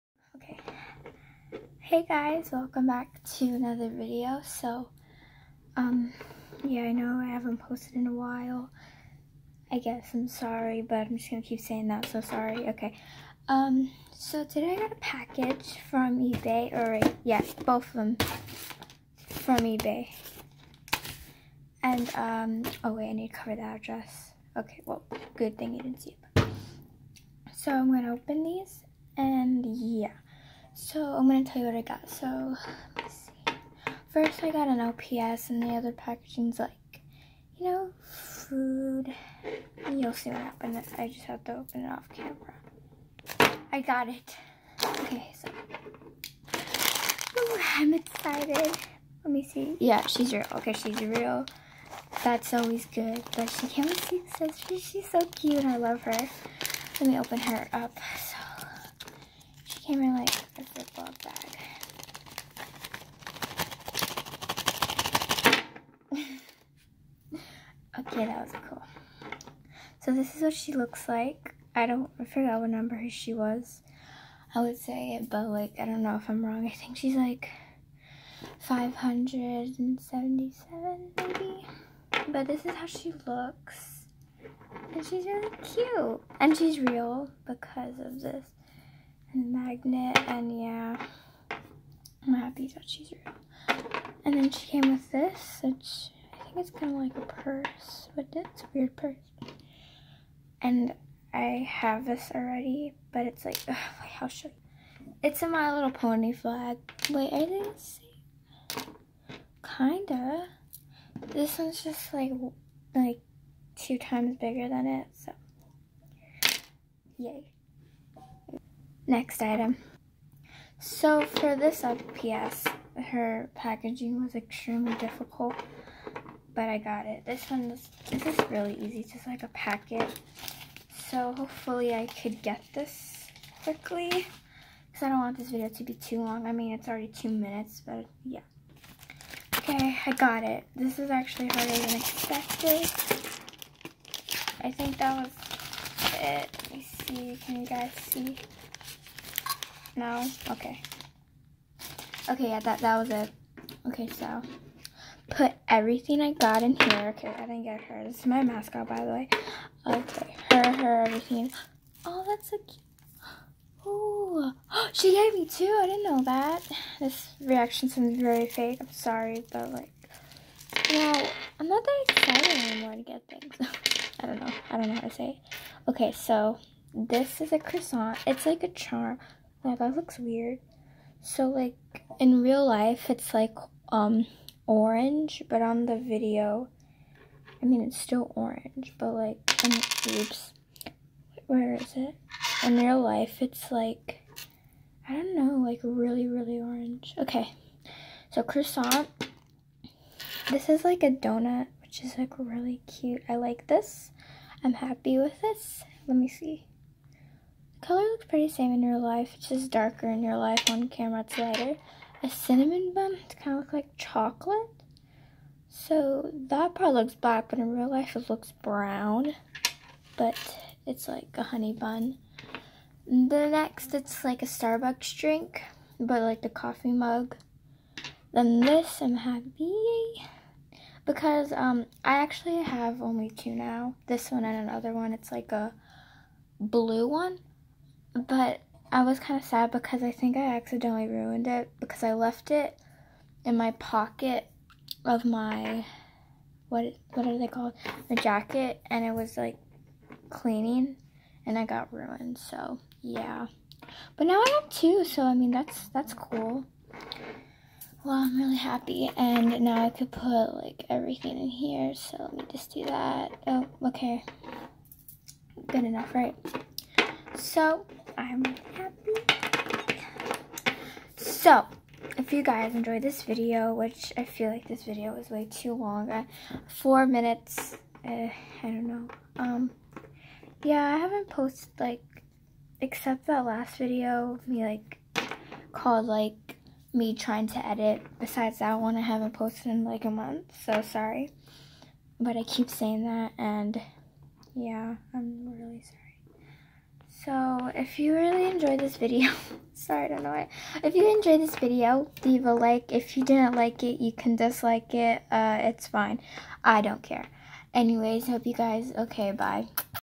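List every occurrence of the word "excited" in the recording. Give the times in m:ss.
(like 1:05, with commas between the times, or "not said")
0:47, 2:52.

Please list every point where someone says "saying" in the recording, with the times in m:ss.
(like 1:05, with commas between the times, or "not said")
0:11, 4:52.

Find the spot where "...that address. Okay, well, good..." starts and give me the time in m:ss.
0:23.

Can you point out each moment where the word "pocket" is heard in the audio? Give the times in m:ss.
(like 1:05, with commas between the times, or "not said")
4:03.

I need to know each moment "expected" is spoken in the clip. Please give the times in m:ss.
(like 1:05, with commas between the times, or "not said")
2:21.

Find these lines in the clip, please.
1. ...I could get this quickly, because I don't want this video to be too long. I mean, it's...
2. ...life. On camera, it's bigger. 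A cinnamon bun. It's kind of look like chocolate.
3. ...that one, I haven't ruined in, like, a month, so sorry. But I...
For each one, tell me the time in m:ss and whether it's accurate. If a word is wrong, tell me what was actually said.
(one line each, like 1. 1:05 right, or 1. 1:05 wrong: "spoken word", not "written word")
1. 2:11 right
2. 3:30 wrong: "lighter", not "bigger"
3. 4:48 wrong: "posted", not "ruined".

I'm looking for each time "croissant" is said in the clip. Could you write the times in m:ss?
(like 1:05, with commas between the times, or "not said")
2:57, 3:18.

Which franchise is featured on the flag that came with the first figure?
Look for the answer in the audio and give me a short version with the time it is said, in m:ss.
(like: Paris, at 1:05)
My Little Pony, at 1:45.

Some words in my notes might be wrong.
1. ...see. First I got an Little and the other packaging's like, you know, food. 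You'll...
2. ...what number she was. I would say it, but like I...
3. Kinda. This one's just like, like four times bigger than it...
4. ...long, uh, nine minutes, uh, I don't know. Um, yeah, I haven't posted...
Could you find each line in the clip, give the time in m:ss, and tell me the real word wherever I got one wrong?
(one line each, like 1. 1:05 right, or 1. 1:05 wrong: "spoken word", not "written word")
1. 0:33 wrong: "LPS", not "Little"
2. 1:12 right
3. 1:49 wrong: "two", not "four"
4. 4:35 wrong: "four", not "nine".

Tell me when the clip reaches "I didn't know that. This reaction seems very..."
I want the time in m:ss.
2:45.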